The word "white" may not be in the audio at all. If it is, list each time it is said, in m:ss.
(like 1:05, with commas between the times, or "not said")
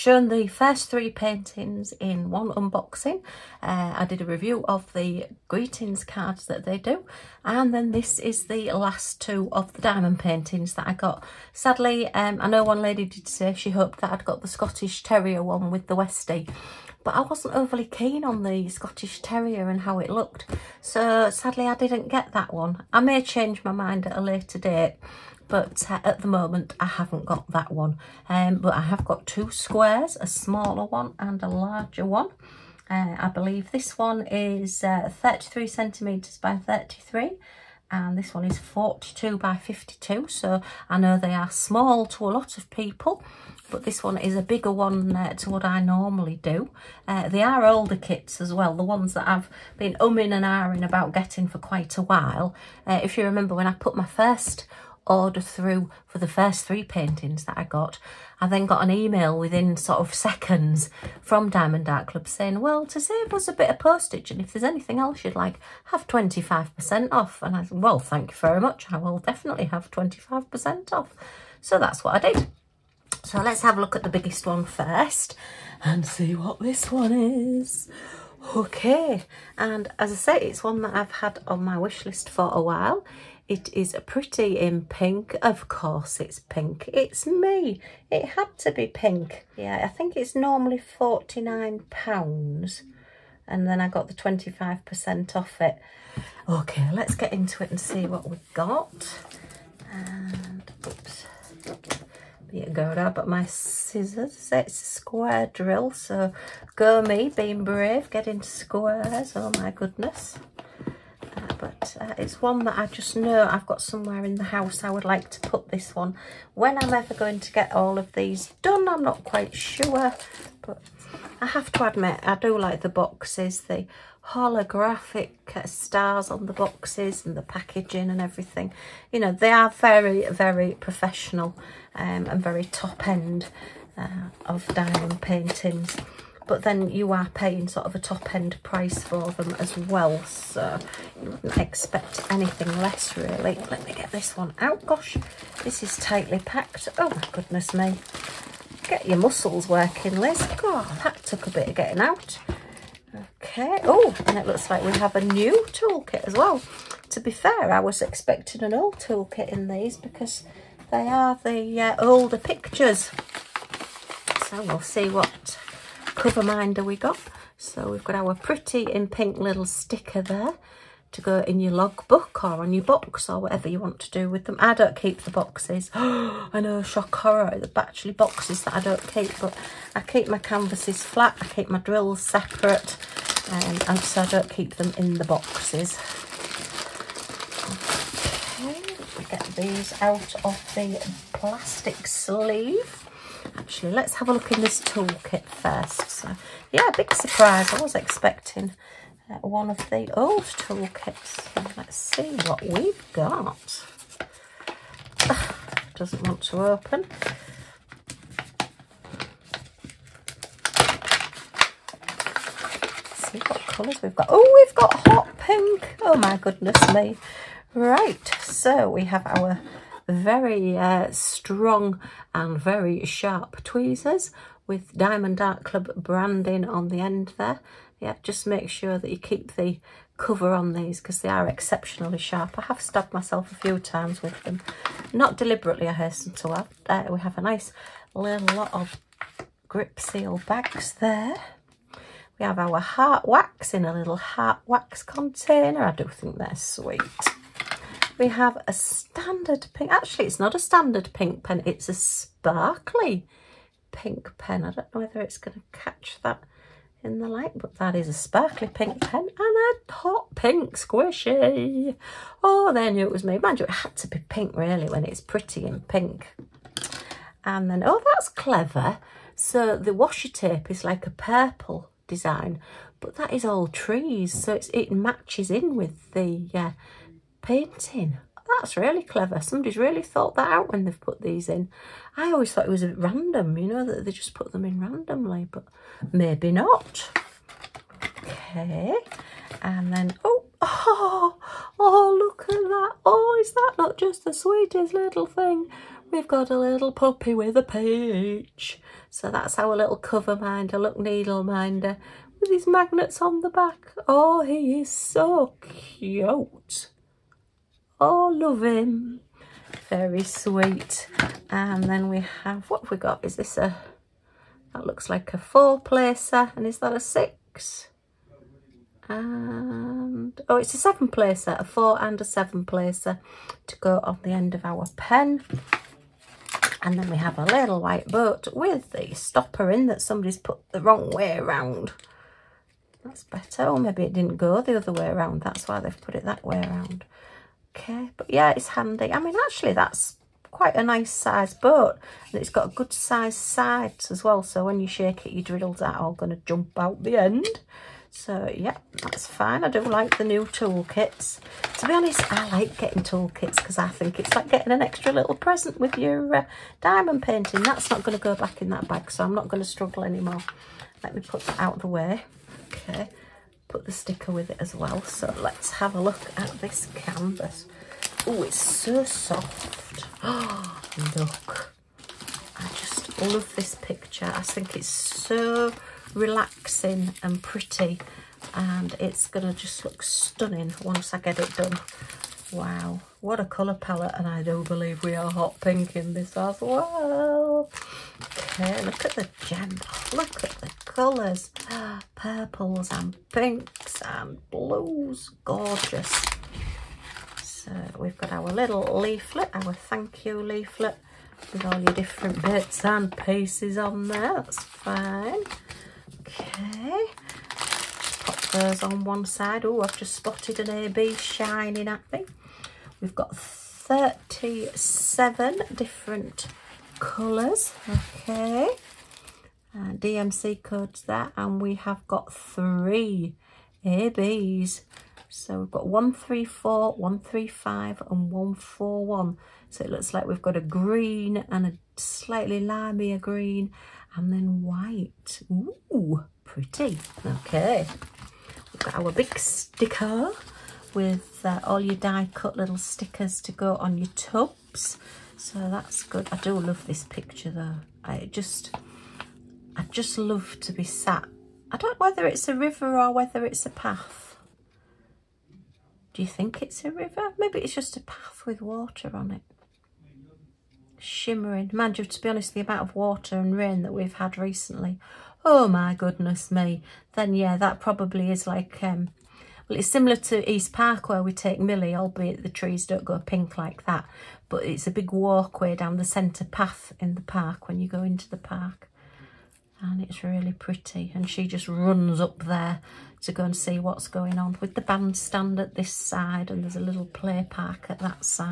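5:27, 7:14.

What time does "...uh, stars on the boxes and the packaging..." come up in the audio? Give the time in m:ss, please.
2:05.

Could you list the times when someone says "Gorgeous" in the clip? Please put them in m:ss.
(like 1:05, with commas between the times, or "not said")
6:35.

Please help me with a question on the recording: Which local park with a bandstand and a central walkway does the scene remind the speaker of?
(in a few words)
East Park.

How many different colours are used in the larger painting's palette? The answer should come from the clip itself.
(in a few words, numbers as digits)
37.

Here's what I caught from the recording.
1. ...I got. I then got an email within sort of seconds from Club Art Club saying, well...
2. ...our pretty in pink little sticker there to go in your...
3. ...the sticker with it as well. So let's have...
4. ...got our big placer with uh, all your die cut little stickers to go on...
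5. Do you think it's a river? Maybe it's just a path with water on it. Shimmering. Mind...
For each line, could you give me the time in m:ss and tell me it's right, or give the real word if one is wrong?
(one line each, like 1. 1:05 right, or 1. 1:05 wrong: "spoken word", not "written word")
1. 0:57 wrong: "Diamond", not "Club"
2. 2:48 right
3. 6:03 right
4. 7:18 wrong: "sticker", not "placer"
5. 7:36 right.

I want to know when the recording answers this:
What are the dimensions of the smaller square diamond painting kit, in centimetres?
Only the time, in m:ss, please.
0:35.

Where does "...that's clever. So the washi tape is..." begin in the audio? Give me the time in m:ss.
4:28.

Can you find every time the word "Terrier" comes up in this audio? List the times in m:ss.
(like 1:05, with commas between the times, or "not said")
0:15, 0:19.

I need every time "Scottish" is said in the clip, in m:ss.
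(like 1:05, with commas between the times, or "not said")
0:14, 0:18.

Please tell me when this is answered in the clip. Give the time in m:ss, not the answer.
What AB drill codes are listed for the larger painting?
7:05.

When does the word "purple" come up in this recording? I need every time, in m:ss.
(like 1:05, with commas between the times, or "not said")
4:31, 6:32.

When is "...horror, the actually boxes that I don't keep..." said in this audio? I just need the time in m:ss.
2:57.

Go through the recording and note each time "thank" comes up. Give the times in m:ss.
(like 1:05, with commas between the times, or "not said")
1:07, 6:39.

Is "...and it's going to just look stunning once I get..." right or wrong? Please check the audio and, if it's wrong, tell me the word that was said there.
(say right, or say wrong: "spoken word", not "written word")
right.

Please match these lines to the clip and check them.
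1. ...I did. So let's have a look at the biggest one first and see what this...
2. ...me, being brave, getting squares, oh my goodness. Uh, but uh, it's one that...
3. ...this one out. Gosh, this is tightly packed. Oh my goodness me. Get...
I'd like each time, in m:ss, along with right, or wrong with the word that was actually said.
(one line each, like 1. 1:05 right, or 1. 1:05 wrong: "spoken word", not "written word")
1. 1:12 right
2. 1:47 right
3. 2:24 right.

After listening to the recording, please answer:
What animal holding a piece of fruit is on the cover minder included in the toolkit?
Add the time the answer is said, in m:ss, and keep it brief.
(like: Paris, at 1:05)
Puppy, at 4:56.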